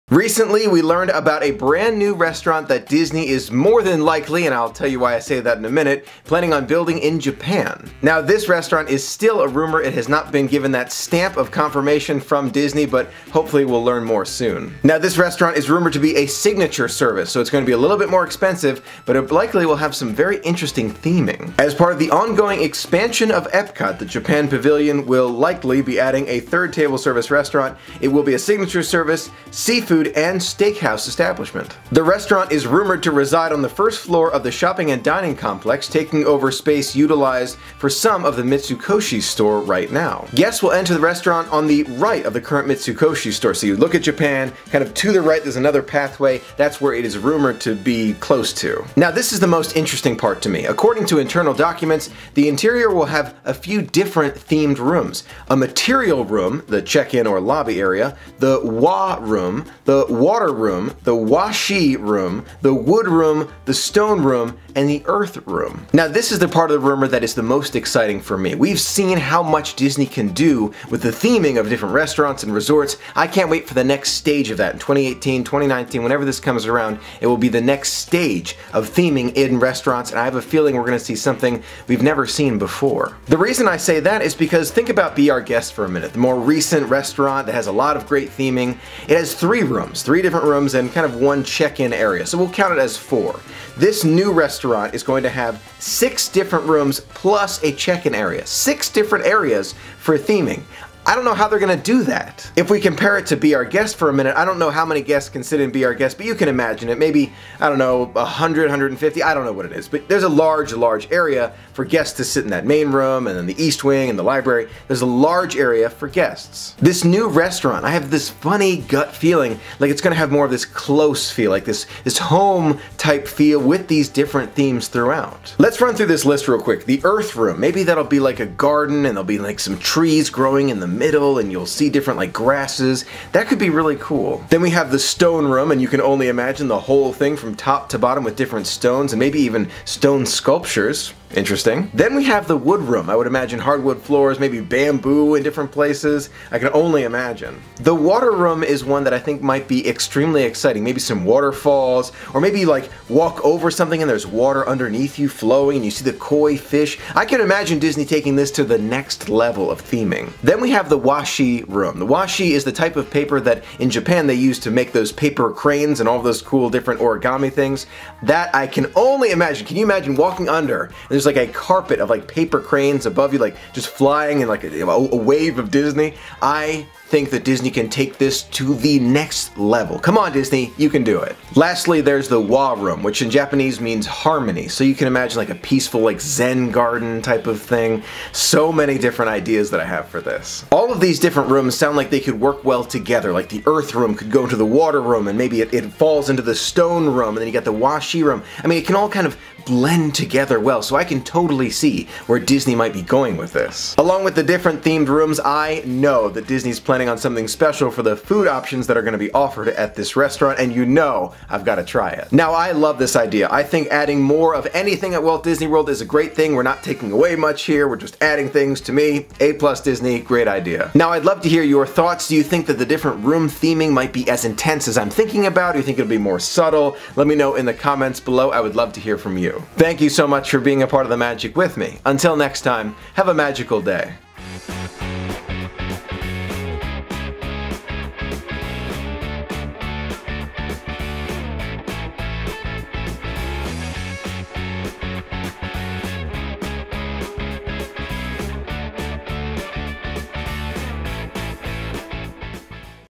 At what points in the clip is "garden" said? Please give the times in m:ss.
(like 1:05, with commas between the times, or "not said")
2:08, 3:06.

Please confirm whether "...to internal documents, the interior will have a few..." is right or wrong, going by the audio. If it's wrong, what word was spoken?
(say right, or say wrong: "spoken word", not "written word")
right.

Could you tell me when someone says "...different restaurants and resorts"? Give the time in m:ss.
1:11.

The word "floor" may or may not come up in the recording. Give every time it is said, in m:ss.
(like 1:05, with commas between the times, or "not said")
0:34, 2:24.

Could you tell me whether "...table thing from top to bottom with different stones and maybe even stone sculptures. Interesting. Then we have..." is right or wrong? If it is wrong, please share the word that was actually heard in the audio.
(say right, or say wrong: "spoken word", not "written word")
wrong: "whole", not "table".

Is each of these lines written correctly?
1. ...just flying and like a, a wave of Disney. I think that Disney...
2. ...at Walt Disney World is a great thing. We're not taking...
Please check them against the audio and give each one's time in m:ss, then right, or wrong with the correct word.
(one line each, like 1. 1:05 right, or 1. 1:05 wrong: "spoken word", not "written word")
1. 2:53 right
2. 3:35 right.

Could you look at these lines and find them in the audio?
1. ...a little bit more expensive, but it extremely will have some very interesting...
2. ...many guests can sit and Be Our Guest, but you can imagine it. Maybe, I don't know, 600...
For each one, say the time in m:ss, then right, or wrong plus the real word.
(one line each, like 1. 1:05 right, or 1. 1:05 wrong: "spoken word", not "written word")
1. 0:17 wrong: "likely", not "extremely"
2. 1:44 wrong: "100", not "600".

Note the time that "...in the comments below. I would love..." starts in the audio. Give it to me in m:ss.
3:47.